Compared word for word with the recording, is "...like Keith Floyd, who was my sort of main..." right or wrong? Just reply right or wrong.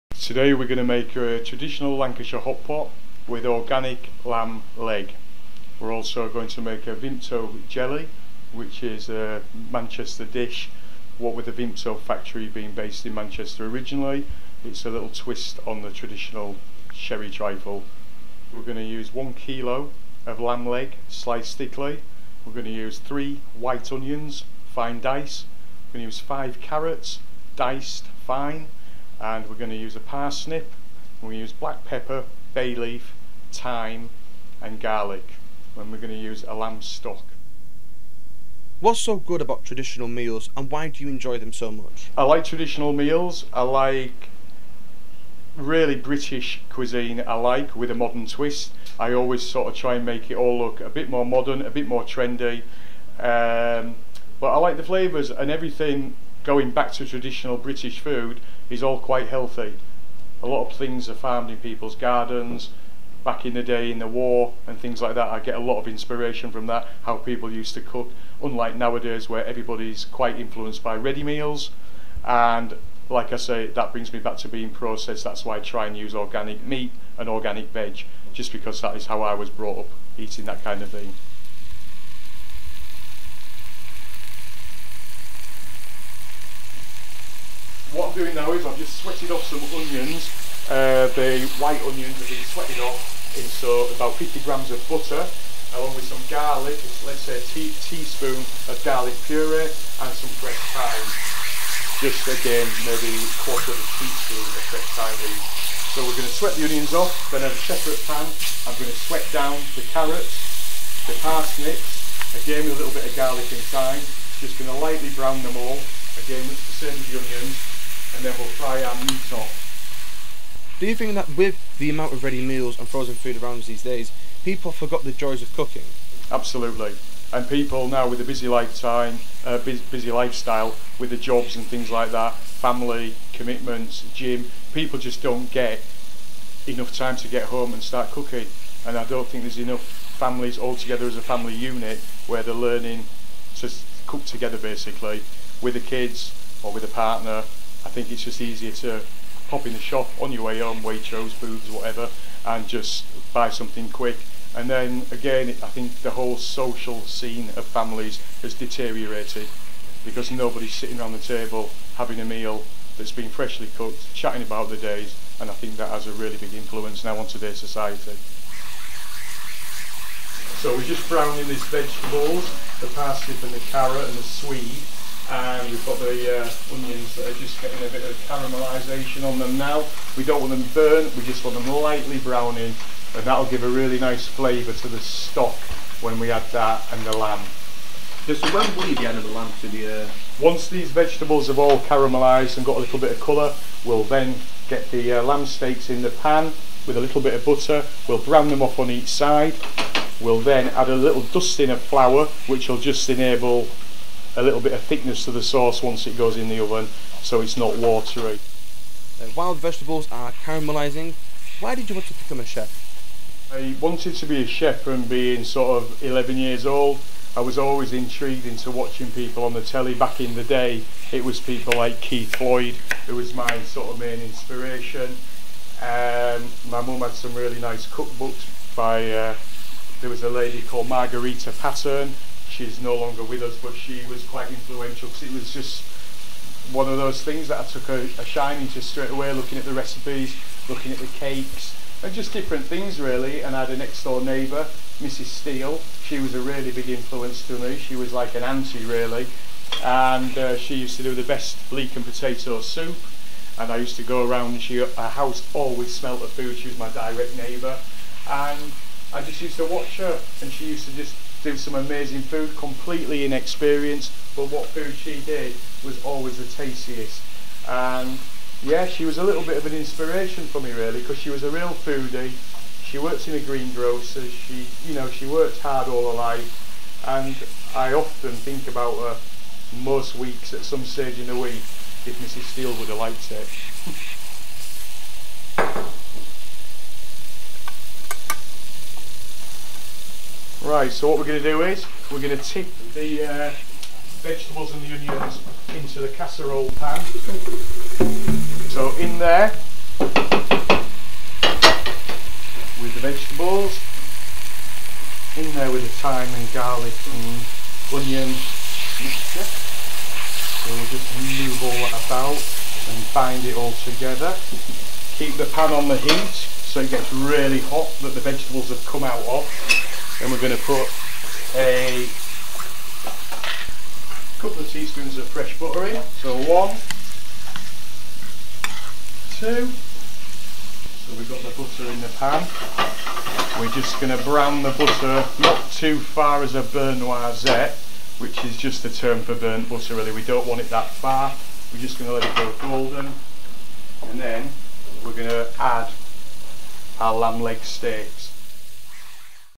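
right.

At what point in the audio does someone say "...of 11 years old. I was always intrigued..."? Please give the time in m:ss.
3:35.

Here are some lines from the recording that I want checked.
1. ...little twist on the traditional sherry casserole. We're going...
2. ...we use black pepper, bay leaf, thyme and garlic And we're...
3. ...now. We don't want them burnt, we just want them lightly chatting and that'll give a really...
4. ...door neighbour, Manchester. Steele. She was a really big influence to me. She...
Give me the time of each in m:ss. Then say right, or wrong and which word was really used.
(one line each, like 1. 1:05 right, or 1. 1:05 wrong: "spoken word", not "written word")
1. 0:14 wrong: "trifle", not "casserole"
2. 0:31 right
3. 2:59 wrong: "browning", not "chatting"
4. 4:04 wrong: "Mrs", not "Manchester".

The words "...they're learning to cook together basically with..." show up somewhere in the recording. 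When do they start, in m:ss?
2:22.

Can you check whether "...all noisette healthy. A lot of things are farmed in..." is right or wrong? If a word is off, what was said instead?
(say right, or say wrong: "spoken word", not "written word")
wrong: "quite", not "noisette".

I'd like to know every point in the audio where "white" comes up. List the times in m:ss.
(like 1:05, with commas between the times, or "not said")
0:23, 1:31.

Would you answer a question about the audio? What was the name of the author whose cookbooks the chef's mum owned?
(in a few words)
Marguerite Patten.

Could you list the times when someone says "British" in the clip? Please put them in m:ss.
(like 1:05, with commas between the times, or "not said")
0:45, 0:57.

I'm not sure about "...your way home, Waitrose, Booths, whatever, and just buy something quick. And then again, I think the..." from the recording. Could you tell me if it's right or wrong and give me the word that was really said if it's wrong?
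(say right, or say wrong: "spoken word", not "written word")
right.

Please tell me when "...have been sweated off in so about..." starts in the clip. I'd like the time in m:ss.
1:32.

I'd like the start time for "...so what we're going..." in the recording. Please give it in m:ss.
4:50.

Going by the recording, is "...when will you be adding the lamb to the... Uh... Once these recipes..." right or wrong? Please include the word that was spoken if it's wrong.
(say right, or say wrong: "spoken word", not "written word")
wrong: "vegetables", not "recipes".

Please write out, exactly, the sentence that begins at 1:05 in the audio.
I get a lot of inspiration from that, how people used to cook, unlike nowadays where everybody's quite influenced by ready meals.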